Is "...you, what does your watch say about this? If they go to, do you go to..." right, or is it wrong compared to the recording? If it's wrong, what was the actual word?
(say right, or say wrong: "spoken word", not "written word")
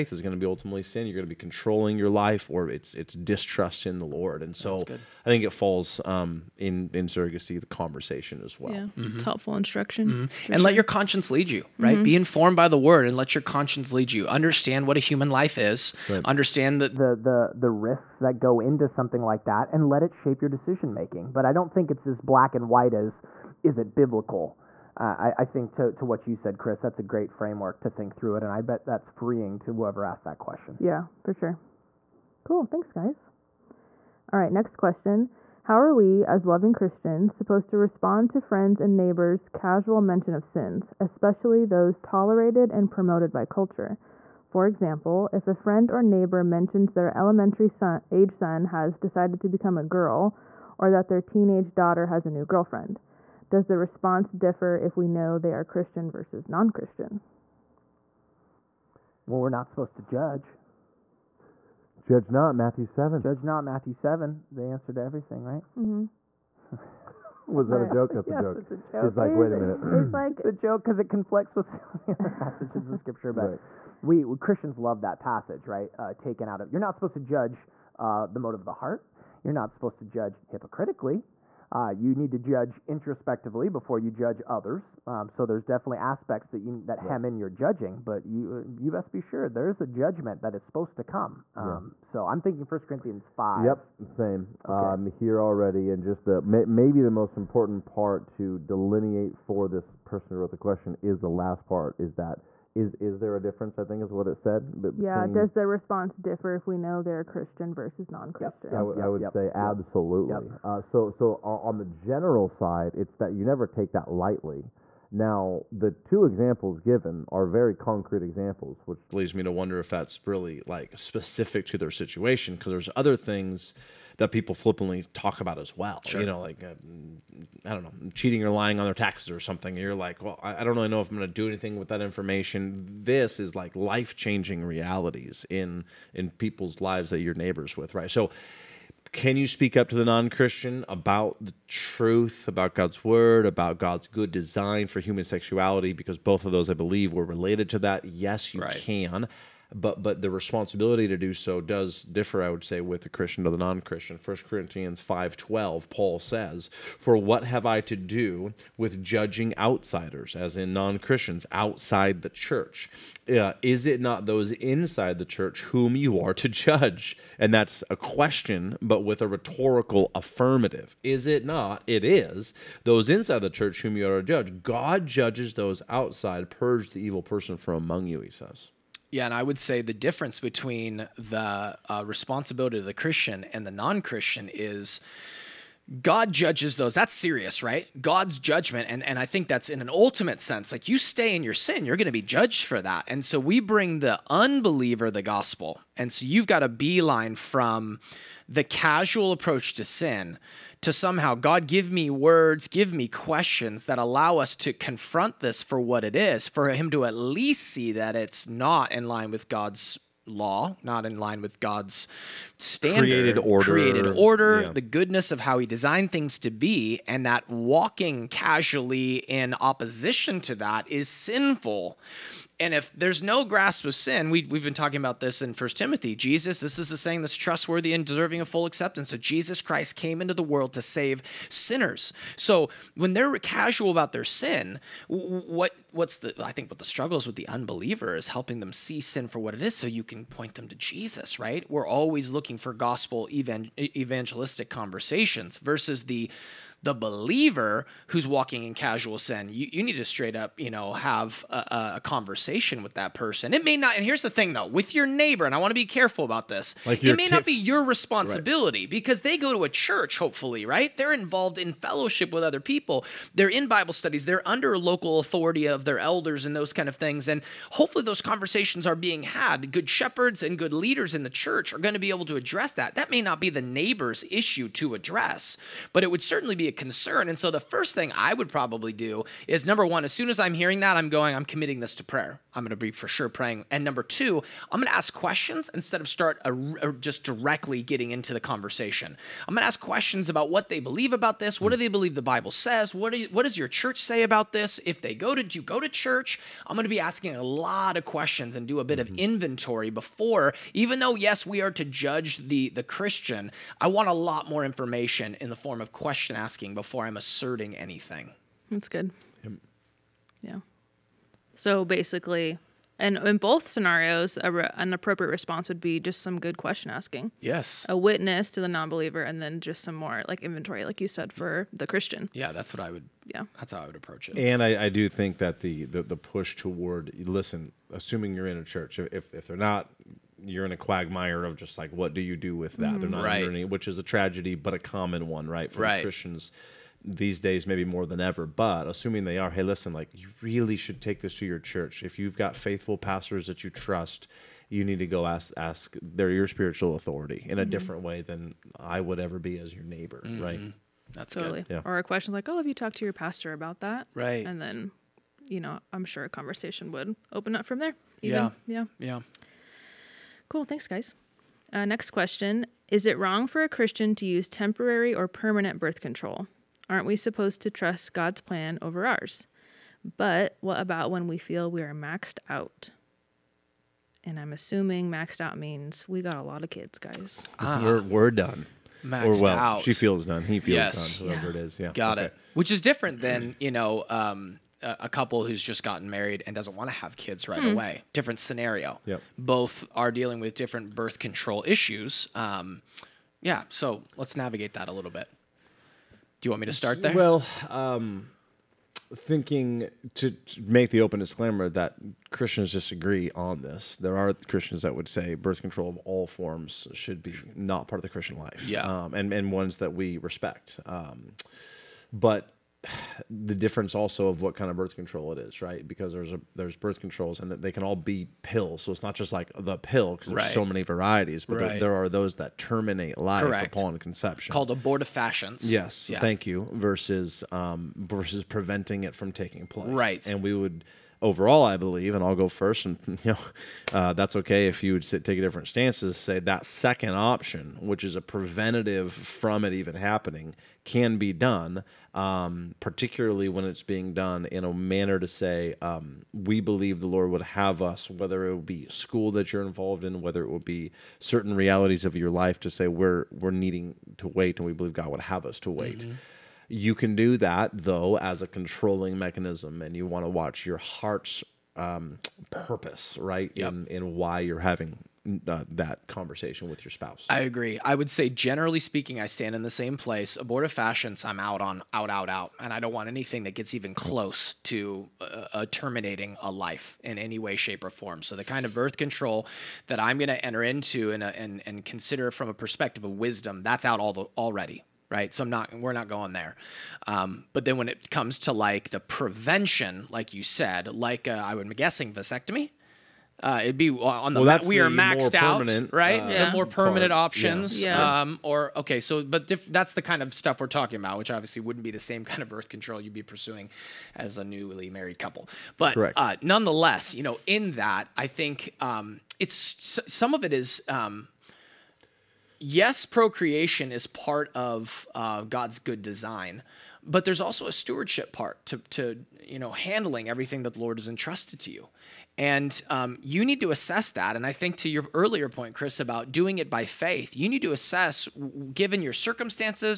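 wrong: "church", not "watch".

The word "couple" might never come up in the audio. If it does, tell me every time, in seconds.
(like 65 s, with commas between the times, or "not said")
385 s, 505 s.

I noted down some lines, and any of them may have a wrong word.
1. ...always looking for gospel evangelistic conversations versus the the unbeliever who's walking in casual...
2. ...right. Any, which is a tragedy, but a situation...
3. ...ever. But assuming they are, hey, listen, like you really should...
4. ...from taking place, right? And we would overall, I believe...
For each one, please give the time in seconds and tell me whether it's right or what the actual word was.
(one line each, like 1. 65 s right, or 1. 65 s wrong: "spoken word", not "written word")
1. 241 s wrong: "believer", not "unbeliever"
2. 333 s wrong: "common", not "situation"
3. 338 s right
4. 429 s right.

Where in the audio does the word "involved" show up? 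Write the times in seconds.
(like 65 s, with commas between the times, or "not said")
261 s, 449 s.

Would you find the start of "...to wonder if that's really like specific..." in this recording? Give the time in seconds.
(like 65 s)
119 s.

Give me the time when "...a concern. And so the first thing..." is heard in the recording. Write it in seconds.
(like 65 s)
276 s.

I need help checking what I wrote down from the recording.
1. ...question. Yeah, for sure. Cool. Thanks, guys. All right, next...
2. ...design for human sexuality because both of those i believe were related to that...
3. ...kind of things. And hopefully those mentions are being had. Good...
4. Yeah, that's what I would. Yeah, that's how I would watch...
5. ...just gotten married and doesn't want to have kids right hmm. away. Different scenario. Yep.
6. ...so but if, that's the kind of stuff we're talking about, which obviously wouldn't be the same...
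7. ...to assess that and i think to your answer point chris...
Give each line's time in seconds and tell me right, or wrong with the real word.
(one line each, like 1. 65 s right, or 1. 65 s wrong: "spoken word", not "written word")
1. 30 s right
2. 144 s right
3. 266 s wrong: "conversations", not "mentions"
4. 322 s wrong: "approach", not "watch"
5. 385 s right
6. 498 s right
7. 523 s wrong: "earlier", not "answer".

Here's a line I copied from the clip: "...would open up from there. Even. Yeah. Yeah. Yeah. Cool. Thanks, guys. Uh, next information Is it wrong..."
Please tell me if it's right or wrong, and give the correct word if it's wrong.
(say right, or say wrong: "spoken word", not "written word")
wrong: "question", not "information".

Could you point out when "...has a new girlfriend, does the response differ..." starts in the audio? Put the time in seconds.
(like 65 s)
52 s.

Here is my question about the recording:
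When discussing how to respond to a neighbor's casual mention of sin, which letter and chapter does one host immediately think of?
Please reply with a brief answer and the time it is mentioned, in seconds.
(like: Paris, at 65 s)
First Corinthians 5, at 92 s.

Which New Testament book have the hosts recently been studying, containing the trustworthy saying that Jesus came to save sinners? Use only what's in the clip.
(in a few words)
First Timothy.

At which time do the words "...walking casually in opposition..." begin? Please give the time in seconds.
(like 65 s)
217 s.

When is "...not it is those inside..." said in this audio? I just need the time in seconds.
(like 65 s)
171 s.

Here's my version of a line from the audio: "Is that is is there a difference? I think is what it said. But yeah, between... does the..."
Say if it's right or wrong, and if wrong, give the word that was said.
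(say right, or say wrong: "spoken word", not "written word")
right.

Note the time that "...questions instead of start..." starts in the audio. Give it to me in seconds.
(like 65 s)
285 s.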